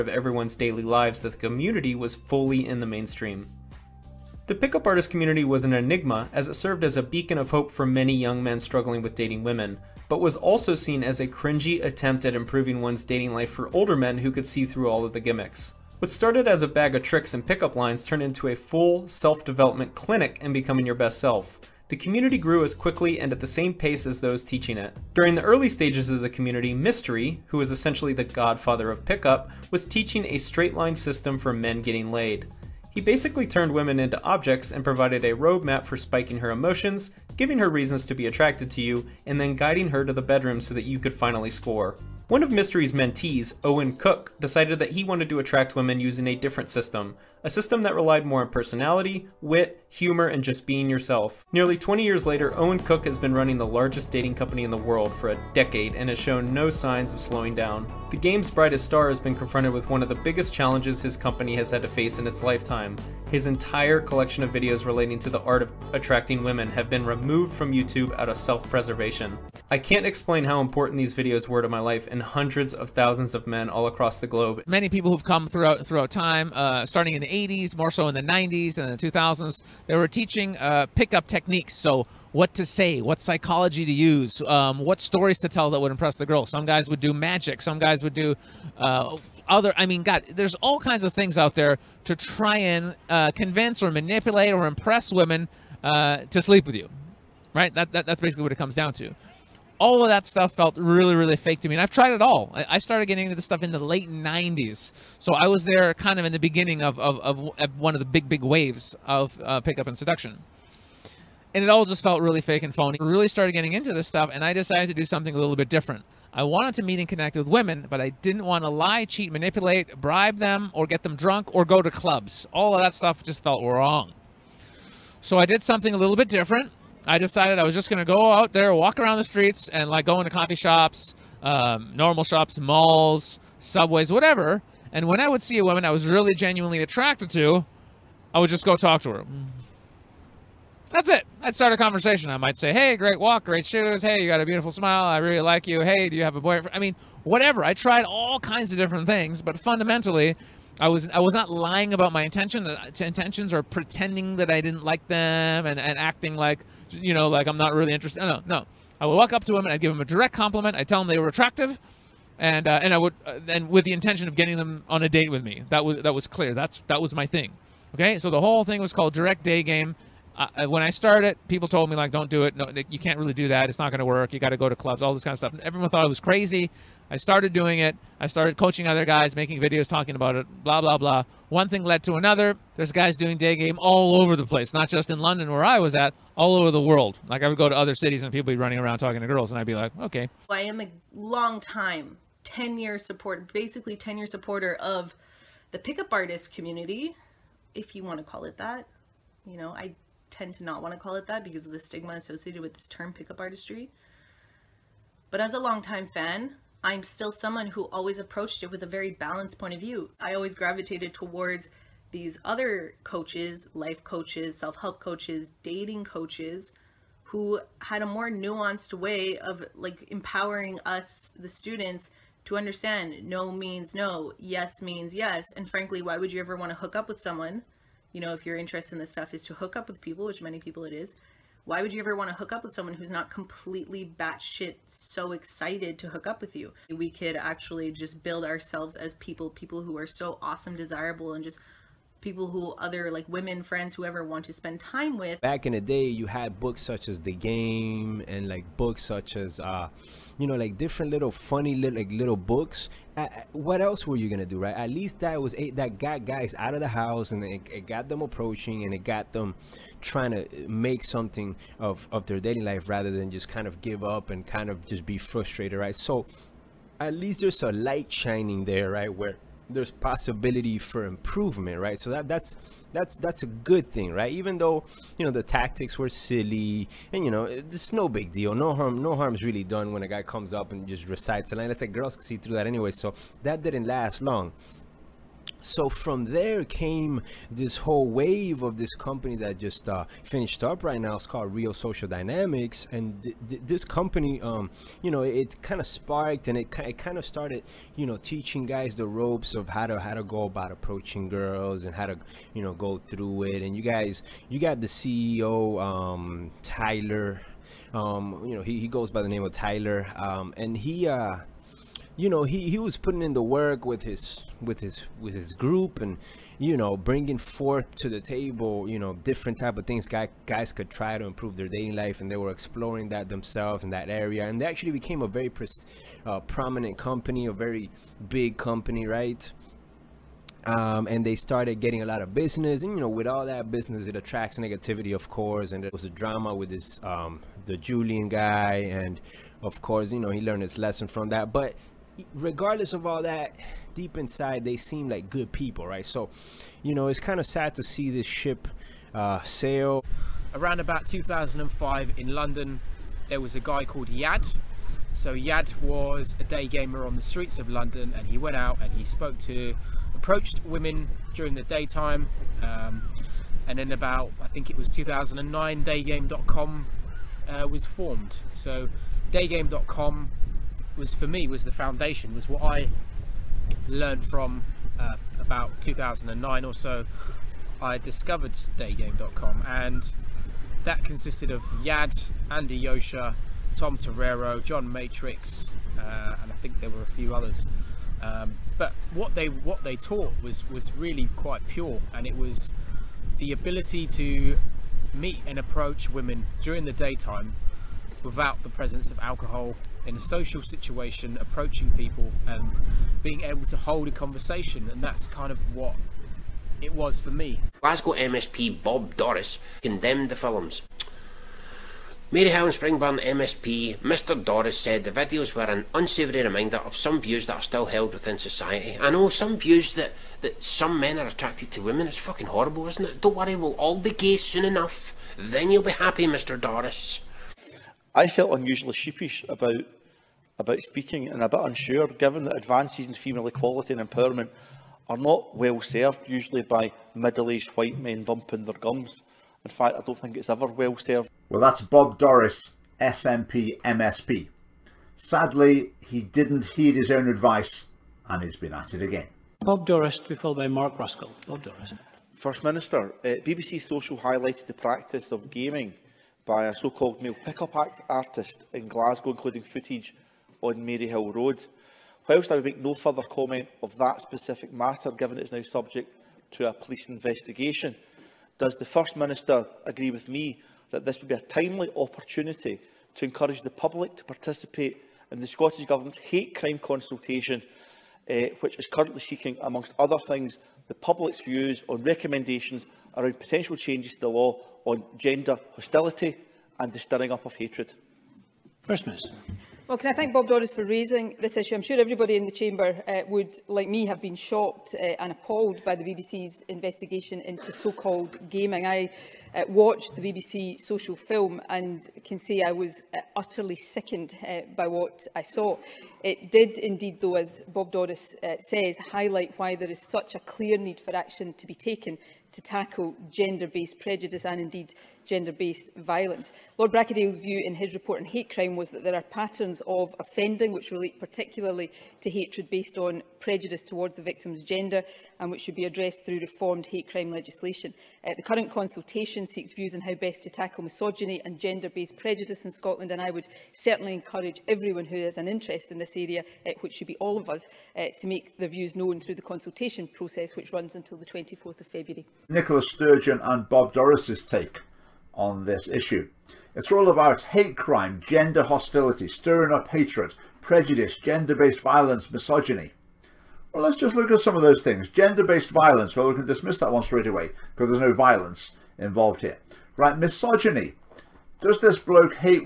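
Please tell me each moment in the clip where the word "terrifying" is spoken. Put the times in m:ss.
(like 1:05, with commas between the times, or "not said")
not said.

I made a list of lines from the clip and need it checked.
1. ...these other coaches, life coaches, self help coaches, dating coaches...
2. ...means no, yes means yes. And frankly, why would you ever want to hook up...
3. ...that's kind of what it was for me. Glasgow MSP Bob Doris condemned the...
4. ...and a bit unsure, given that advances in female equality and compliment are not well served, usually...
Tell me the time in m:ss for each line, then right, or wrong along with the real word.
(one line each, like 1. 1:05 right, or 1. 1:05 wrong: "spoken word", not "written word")
1. 3:32 right
2. 3:43 right
3. 6:45 right
4. 7:11 wrong: "empowerment", not "compliment".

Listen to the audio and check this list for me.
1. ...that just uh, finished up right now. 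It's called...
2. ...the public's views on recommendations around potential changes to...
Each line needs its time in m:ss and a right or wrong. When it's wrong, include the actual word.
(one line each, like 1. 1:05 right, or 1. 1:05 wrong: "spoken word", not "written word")
1. 4:49 right
2. 8:00 right.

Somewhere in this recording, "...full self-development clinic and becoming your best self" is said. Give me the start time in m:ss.
0:18.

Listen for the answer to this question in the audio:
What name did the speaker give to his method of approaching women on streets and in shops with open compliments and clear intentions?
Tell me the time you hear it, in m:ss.
2:49.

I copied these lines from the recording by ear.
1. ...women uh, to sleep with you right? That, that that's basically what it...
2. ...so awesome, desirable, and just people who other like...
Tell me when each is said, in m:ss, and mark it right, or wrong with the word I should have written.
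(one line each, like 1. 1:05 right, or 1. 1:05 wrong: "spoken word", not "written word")
1. 1:35 right
2. 4:00 right.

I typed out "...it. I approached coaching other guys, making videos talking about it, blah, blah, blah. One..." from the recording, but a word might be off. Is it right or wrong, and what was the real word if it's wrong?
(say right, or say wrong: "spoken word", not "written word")
wrong: "started", not "approached".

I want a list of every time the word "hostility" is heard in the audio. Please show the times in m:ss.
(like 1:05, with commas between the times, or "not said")
8:05, 9:08.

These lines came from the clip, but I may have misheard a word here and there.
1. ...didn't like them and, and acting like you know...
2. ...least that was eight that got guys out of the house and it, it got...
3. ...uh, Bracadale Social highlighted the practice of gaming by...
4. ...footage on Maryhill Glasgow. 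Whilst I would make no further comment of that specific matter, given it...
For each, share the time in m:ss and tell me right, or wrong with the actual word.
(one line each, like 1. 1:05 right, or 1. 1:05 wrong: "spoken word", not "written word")
1. 2:34 right
2. 4:14 right
3. 7:33 wrong: "BBC", not "Bracadale"
4. 7:39 wrong: "Road", not "Glasgow".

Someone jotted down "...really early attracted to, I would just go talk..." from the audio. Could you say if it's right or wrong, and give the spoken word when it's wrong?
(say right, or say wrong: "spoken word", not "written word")
wrong: "genuinely", not "early".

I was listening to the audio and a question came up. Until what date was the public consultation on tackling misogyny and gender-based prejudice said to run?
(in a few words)
24 February.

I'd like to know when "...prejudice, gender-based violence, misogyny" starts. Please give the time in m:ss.
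9:10.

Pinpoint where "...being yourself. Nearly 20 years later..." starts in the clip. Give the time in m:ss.
0:50.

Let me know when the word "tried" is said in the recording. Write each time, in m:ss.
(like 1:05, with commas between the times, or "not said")
1:41, 2:27.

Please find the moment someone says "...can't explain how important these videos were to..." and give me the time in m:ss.
1:09.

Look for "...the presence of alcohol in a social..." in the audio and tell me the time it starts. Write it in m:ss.
6:38.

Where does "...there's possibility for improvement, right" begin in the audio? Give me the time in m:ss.
4:29.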